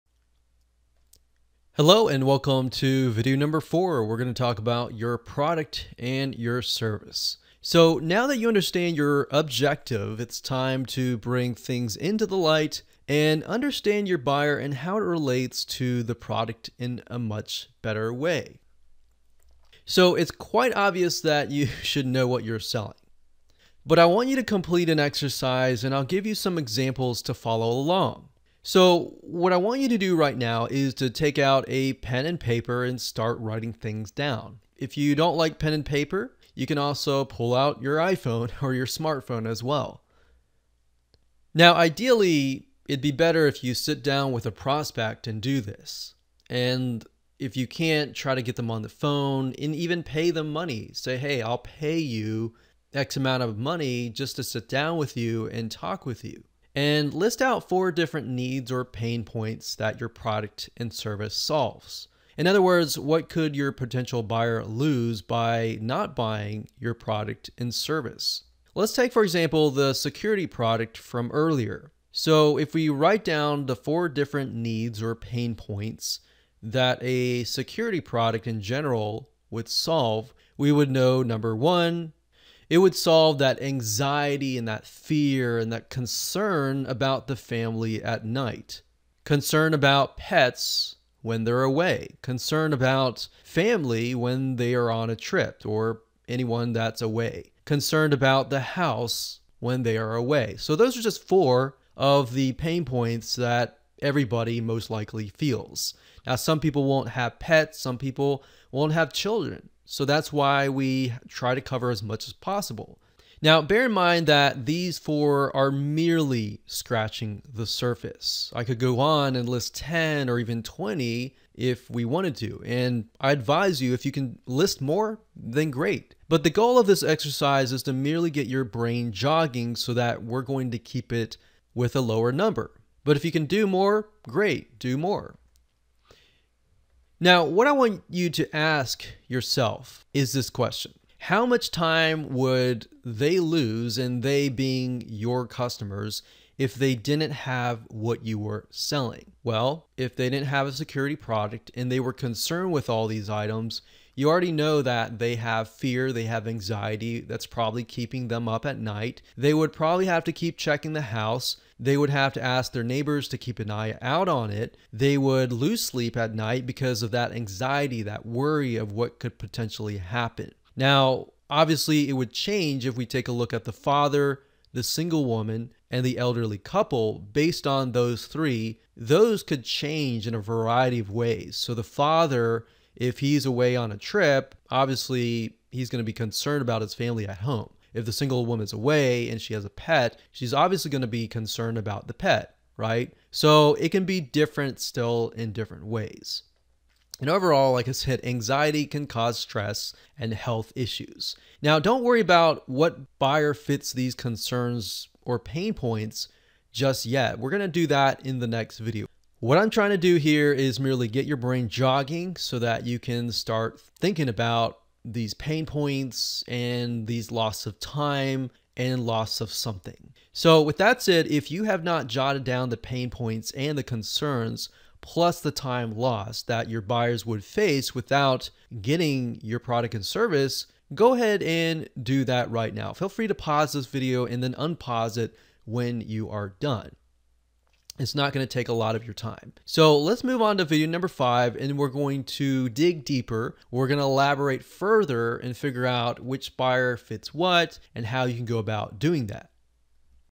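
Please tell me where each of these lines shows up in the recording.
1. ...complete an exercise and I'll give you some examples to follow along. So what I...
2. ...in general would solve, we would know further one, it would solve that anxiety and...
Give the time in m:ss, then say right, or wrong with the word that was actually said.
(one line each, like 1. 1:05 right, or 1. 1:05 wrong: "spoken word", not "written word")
1. 0:24 right
2. 1:18 wrong: "number", not "further".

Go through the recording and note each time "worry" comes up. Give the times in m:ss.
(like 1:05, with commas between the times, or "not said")
2:48, 3:22.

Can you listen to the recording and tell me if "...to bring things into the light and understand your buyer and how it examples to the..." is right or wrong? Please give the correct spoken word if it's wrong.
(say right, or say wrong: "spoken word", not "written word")
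wrong: "relates", not "examples".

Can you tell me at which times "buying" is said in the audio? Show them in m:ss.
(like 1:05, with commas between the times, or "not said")
1:06.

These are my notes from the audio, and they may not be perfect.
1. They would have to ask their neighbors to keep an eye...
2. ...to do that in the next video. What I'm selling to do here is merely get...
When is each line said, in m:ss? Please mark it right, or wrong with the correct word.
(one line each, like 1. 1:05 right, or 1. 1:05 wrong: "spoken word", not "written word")
1. 2:41 right
2. 3:27 wrong: "trying", not "selling".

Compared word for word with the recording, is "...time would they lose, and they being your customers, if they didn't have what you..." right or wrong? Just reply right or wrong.
right.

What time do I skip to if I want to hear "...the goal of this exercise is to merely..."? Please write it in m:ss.
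2:06.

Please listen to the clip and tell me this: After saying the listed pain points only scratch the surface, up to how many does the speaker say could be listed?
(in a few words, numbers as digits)
20.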